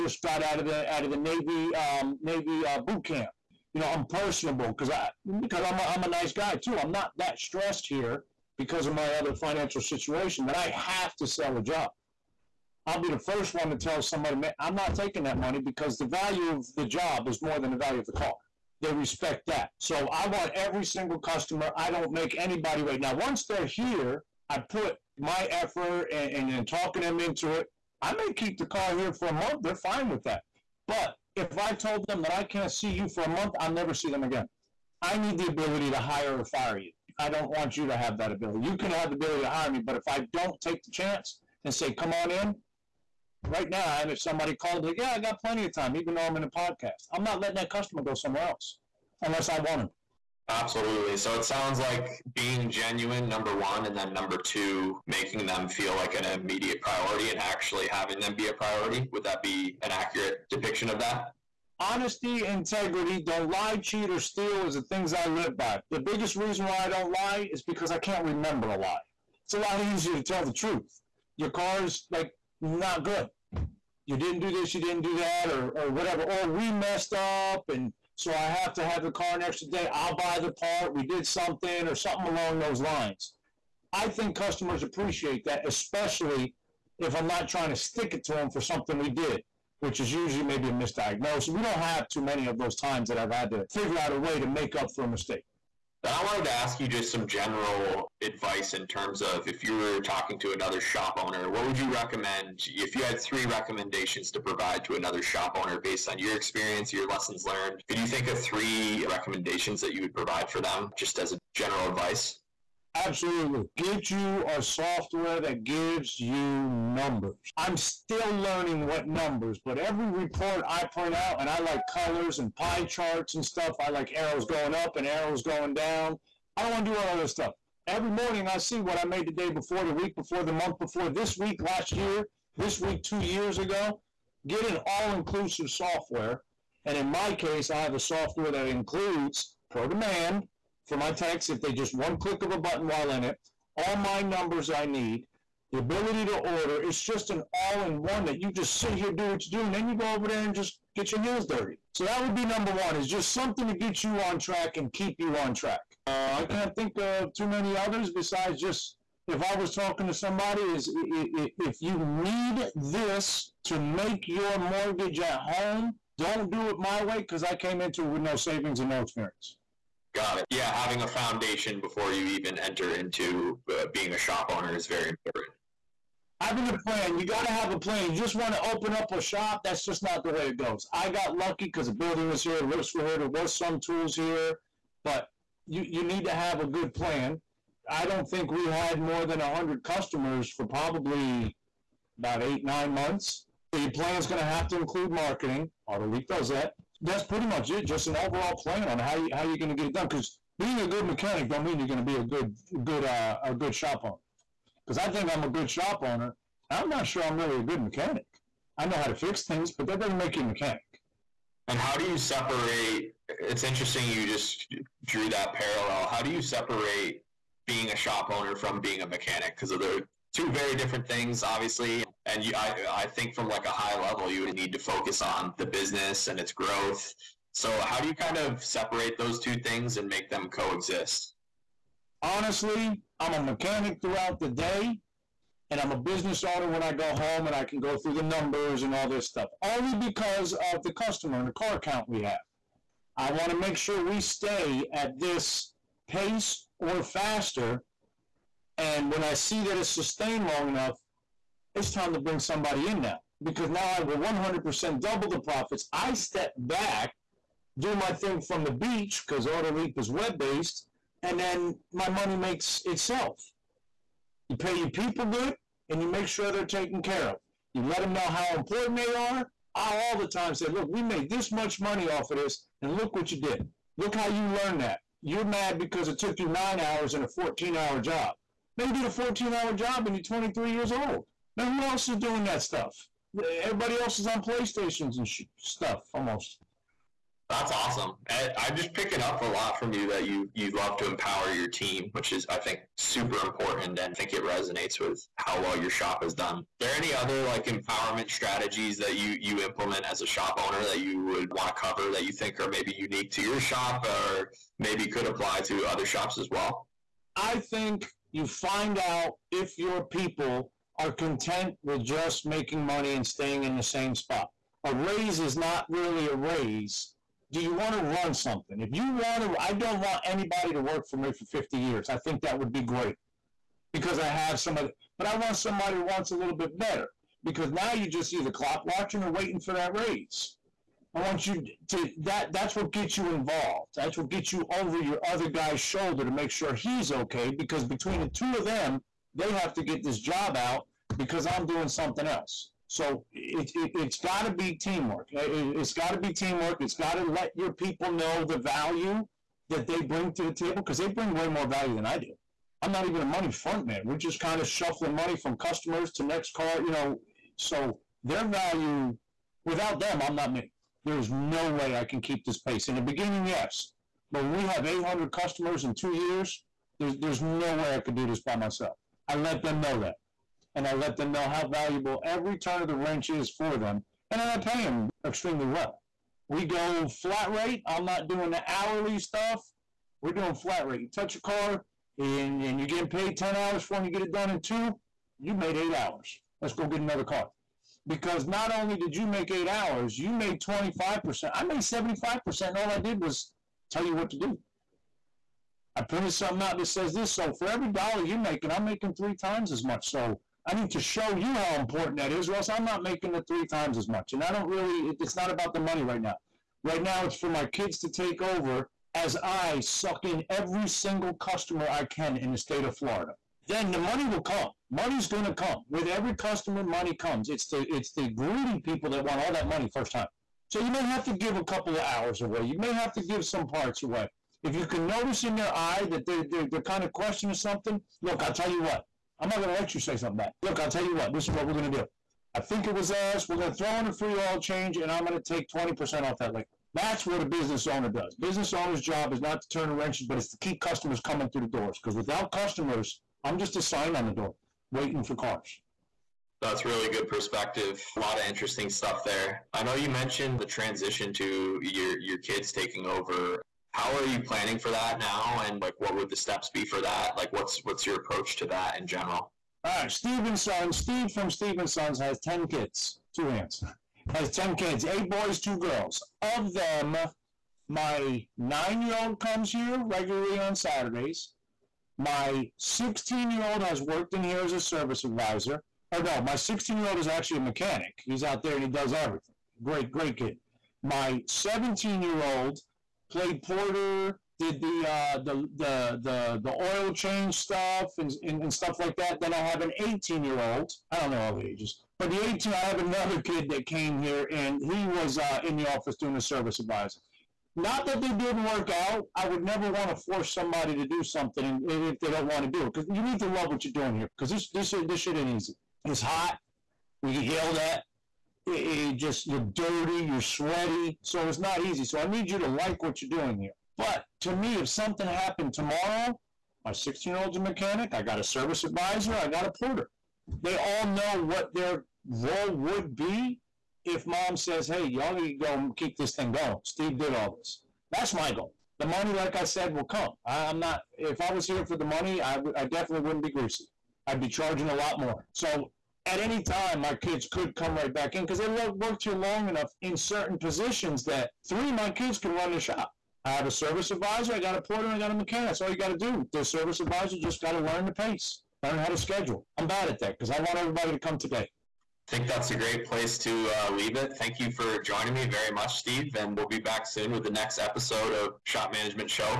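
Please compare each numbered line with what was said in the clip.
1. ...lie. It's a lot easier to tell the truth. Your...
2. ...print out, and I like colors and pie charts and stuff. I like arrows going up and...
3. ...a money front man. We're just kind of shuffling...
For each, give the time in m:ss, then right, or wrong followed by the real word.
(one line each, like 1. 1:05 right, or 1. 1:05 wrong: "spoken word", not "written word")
1. 1:08 right
2. 2:00 right
3. 5:53 right.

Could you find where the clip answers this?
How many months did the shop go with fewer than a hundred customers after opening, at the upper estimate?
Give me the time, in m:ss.
3:12.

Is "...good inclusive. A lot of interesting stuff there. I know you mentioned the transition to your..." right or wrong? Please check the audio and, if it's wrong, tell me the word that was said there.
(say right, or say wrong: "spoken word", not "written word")
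wrong: "perspective", not "inclusive".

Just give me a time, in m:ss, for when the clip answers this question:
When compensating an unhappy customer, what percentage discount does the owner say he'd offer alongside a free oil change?
7:15.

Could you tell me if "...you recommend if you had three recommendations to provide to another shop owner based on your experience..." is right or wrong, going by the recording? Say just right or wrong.
right.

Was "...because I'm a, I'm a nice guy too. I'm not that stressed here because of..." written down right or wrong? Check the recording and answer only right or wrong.
right.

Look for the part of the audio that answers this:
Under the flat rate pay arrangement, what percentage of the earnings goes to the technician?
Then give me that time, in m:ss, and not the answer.
6:30.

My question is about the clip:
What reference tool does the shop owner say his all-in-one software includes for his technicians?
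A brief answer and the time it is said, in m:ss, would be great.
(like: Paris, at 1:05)
ProDemand, at 2:19.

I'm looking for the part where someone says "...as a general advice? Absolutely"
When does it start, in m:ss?
1:51.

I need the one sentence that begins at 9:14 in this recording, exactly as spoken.
Thank you for joining me very much, Steve.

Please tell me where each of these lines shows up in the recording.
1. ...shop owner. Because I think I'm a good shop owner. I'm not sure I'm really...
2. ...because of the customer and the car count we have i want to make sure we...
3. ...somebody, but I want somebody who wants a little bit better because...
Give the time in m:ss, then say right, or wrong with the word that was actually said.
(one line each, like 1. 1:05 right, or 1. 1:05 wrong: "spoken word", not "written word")
1. 3:23 right
2. 3:59 right
3. 5:24 right.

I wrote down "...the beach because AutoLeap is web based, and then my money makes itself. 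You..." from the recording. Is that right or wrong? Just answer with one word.
right.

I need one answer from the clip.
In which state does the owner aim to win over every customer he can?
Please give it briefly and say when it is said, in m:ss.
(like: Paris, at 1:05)
Florida, at 6:52.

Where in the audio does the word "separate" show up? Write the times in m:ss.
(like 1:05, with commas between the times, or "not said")
3:32, 3:36, 3:48.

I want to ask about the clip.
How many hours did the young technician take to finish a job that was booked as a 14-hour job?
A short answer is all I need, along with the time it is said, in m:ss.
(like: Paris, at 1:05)
9, at 4:36.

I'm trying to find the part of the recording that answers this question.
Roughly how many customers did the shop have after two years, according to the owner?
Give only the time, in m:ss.
6:04.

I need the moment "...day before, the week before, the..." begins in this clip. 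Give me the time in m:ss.
2:09.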